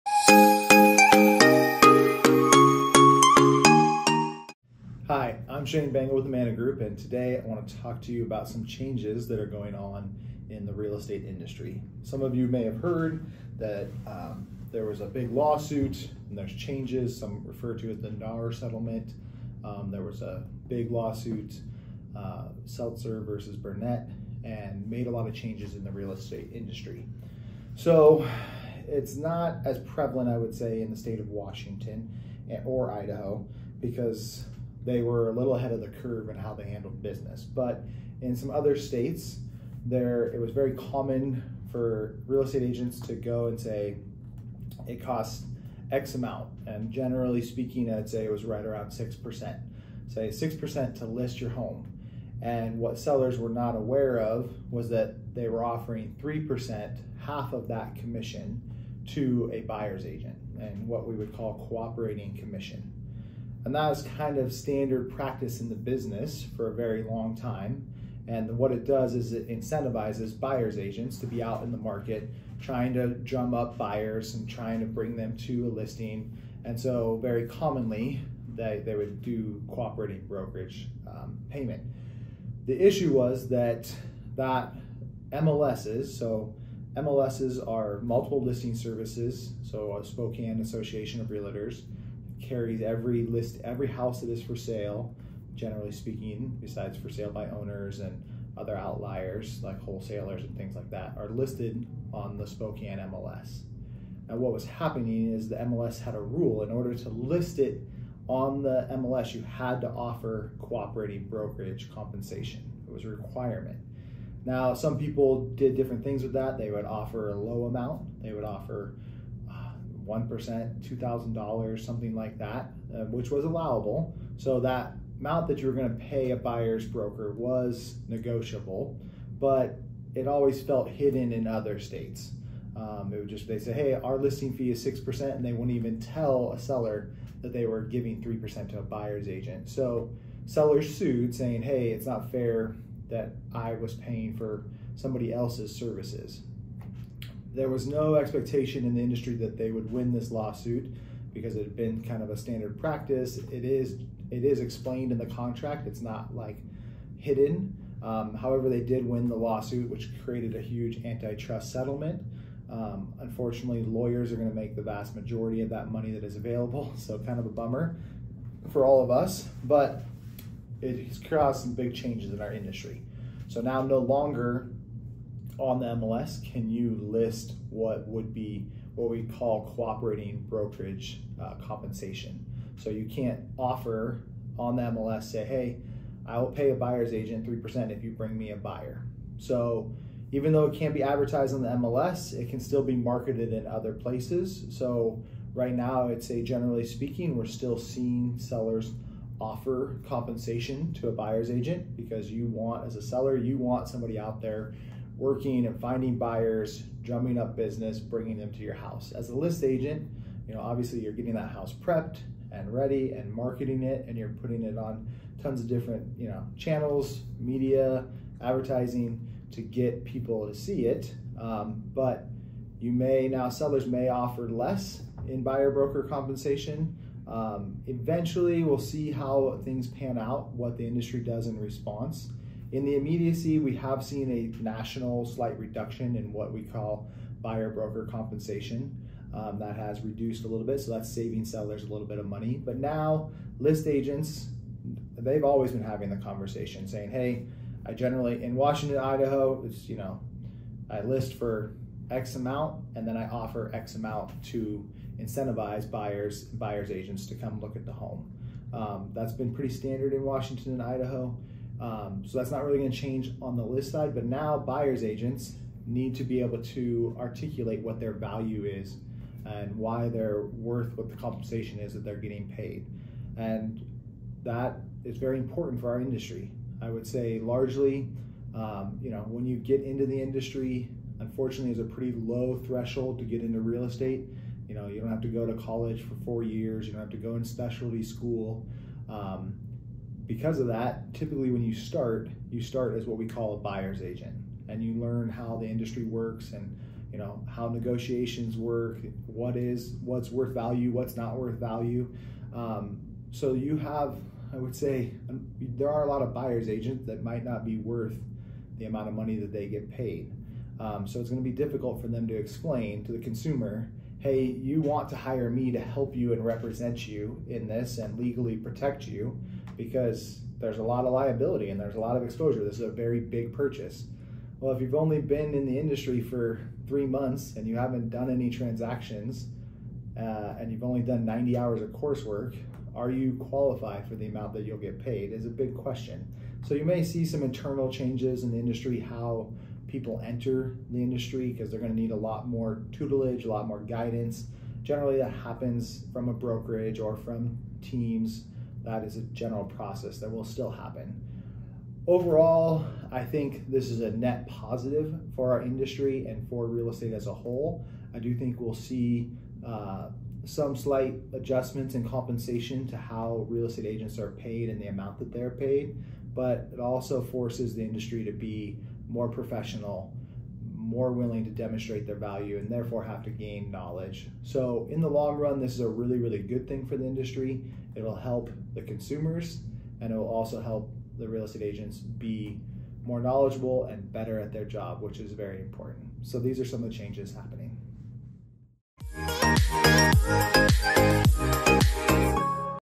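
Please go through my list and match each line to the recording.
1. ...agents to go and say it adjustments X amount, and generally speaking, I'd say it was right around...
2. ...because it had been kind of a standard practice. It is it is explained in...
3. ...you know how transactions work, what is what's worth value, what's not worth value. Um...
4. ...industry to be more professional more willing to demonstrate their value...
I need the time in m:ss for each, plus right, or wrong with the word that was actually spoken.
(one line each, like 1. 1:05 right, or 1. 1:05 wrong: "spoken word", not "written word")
1. 0:42 wrong: "costs", not "adjustments"
2. 2:31 right
3. 4:57 wrong: "negotiations", not "transactions"
4. 6:07 right.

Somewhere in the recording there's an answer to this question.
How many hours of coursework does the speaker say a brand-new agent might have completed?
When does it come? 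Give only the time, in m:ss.
5:31.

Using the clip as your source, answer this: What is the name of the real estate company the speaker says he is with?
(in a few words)
Manna Group.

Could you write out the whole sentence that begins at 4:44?
You know, you don't have to go to college for four years, you don't have to go in specialty school.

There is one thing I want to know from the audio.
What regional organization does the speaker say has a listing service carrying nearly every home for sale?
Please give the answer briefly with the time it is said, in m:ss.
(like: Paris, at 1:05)
Spokane Association of Realtors, at 1:30.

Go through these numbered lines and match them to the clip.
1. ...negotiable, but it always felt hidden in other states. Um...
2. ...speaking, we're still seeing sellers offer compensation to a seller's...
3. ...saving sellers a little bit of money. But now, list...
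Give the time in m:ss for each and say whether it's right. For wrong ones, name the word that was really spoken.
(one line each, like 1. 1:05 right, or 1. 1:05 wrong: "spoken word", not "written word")
1. 2:08 right
2. 3:16 wrong: "buyer", not "seller"
3. 4:01 right.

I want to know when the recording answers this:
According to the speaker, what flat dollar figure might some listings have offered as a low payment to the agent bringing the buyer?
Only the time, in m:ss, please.
2:00.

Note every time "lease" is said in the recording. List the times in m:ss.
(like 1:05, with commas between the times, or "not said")
not said.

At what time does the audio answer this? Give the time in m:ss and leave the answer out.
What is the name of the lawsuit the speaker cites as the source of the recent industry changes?
0:22.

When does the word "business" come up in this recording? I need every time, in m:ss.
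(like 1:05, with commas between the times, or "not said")
0:37, 1:05, 3:27.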